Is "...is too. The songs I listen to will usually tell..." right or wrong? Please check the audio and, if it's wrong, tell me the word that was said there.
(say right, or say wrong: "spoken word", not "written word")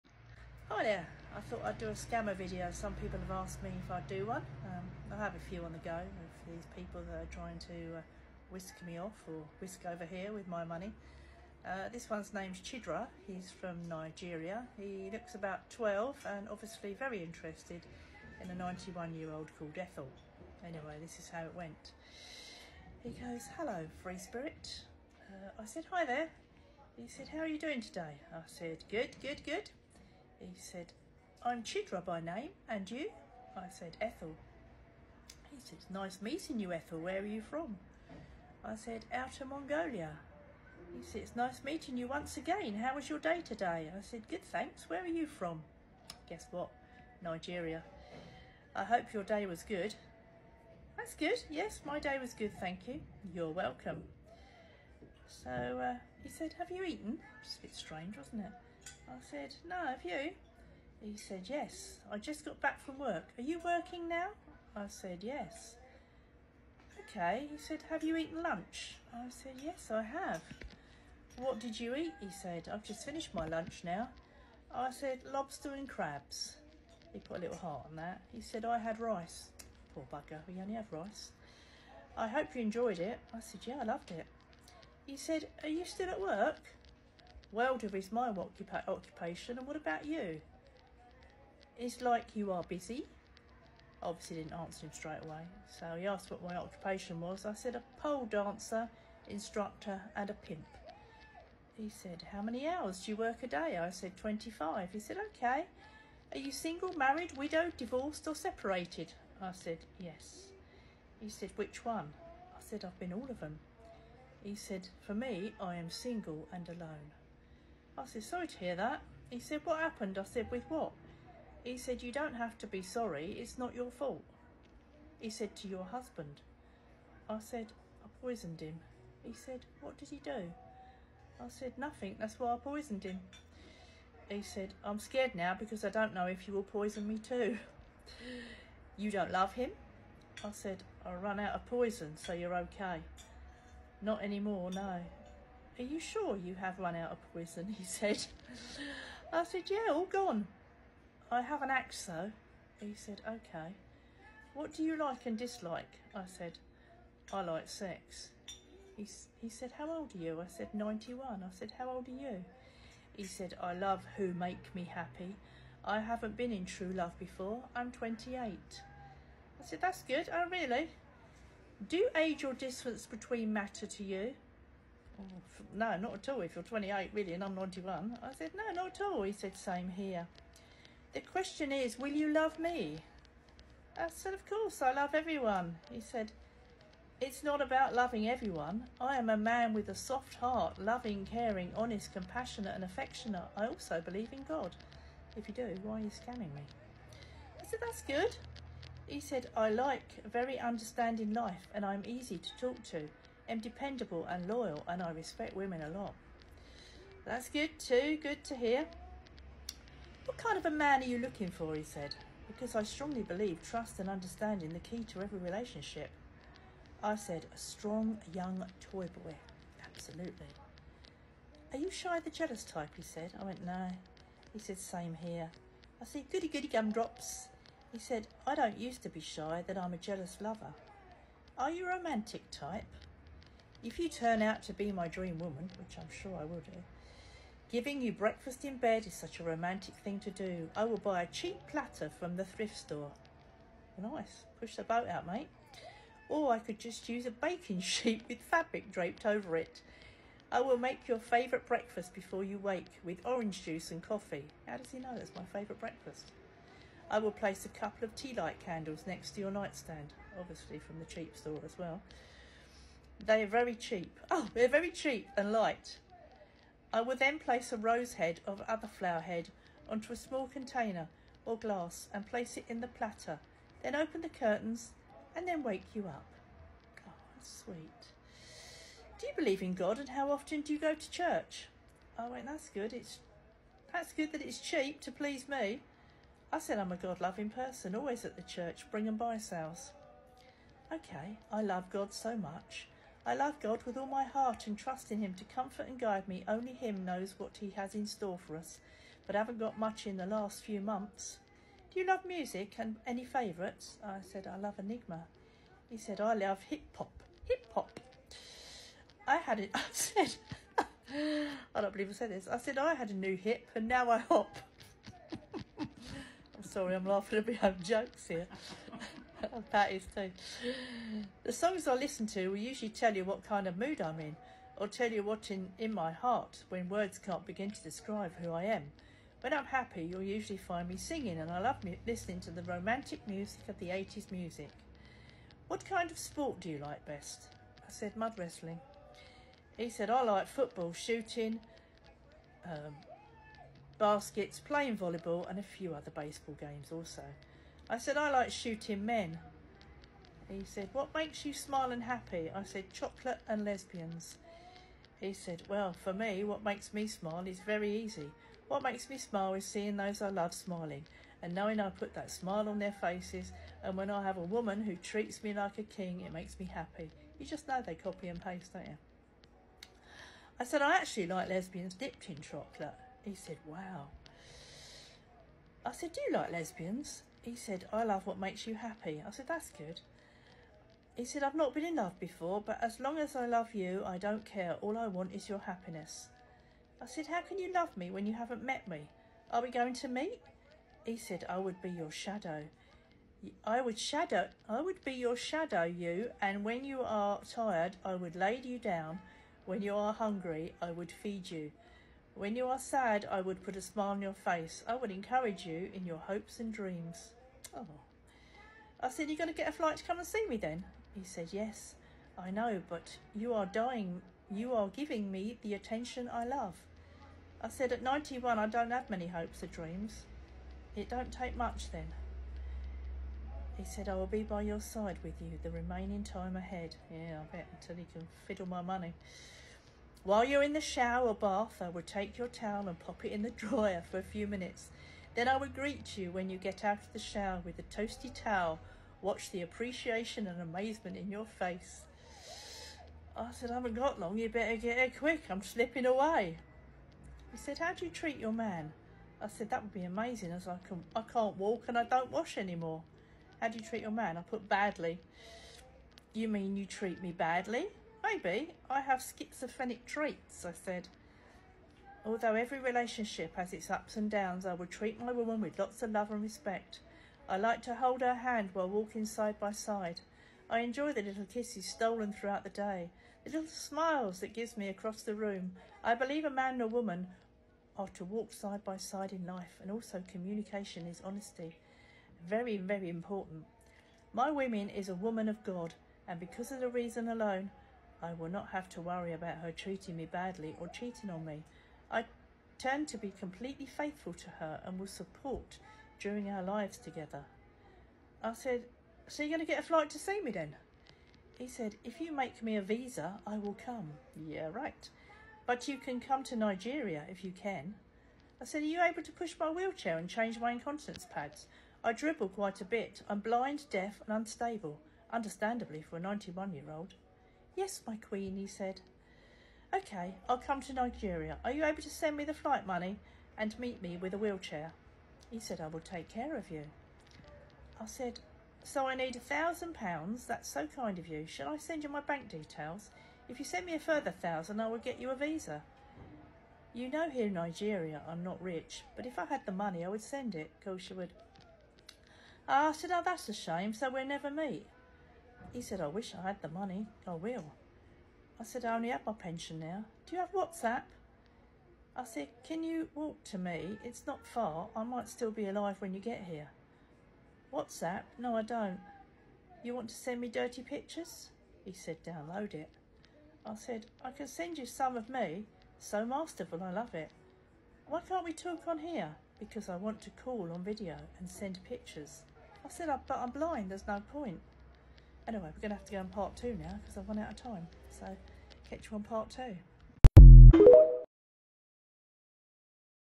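right.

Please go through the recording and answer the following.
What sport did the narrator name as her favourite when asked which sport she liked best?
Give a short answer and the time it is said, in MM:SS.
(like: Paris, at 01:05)
Mud wrestling, at 05:38.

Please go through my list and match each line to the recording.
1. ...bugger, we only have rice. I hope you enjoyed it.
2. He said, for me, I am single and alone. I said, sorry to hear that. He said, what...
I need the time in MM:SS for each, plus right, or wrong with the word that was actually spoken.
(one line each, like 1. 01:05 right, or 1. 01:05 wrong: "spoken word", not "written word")
1. 01:20 right
2. 01:54 right.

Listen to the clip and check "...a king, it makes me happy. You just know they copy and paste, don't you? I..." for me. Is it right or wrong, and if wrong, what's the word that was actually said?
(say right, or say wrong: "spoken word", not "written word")
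right.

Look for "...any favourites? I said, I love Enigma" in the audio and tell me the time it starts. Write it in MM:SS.
05:03.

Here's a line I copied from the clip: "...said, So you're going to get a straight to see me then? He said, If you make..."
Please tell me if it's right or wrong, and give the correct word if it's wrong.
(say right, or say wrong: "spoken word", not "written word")
wrong: "flight", not "straight".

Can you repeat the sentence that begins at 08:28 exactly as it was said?
I said, Are you able to push my wheelchair and change my incontinence pads?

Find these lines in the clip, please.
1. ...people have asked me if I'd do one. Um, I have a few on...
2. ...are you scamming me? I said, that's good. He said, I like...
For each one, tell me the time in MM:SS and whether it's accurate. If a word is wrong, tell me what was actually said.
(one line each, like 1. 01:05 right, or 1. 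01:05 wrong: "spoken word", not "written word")
1. 00:02 right
2. 03:15 right.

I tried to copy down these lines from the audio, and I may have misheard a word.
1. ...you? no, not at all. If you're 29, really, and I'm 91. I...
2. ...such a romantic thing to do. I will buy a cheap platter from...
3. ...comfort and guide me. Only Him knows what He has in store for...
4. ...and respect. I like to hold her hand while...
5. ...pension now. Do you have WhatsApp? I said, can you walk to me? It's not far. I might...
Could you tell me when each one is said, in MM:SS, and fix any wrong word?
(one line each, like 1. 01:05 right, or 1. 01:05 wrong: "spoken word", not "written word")
1. 02:54 wrong: "28", not "29"
2. 03:59 right
3. 04:55 right
4. 07:46 right
5. 09:09 right.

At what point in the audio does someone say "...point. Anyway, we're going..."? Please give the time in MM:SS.
09:34.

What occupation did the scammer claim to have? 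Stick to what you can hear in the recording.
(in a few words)
Welder.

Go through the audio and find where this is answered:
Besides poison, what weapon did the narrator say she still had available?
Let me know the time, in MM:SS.
02:31.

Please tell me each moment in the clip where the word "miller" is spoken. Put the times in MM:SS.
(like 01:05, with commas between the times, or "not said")
not said.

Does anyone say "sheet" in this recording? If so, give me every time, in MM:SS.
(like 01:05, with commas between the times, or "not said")
04:07.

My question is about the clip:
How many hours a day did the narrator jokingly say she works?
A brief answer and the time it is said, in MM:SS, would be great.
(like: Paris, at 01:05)
25, at 01:44.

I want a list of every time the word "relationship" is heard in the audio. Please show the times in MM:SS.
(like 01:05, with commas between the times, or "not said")
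03:35, 07:42.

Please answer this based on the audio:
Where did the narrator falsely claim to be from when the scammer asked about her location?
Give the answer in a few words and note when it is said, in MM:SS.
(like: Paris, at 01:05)
Outer Mongolia, at 00:39.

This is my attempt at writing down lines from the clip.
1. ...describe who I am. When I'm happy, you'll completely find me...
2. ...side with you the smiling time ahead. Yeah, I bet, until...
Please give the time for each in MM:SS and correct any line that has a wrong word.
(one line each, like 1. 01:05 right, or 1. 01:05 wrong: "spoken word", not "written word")
1. 05:27 wrong: "usually", not "completely"
2. 07:04 wrong: "remaining", not "smiling".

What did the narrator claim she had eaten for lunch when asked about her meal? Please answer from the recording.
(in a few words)
Lobster and crabs.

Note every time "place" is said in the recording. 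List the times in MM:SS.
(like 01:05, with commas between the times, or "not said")
04:17, 04:27, 04:32.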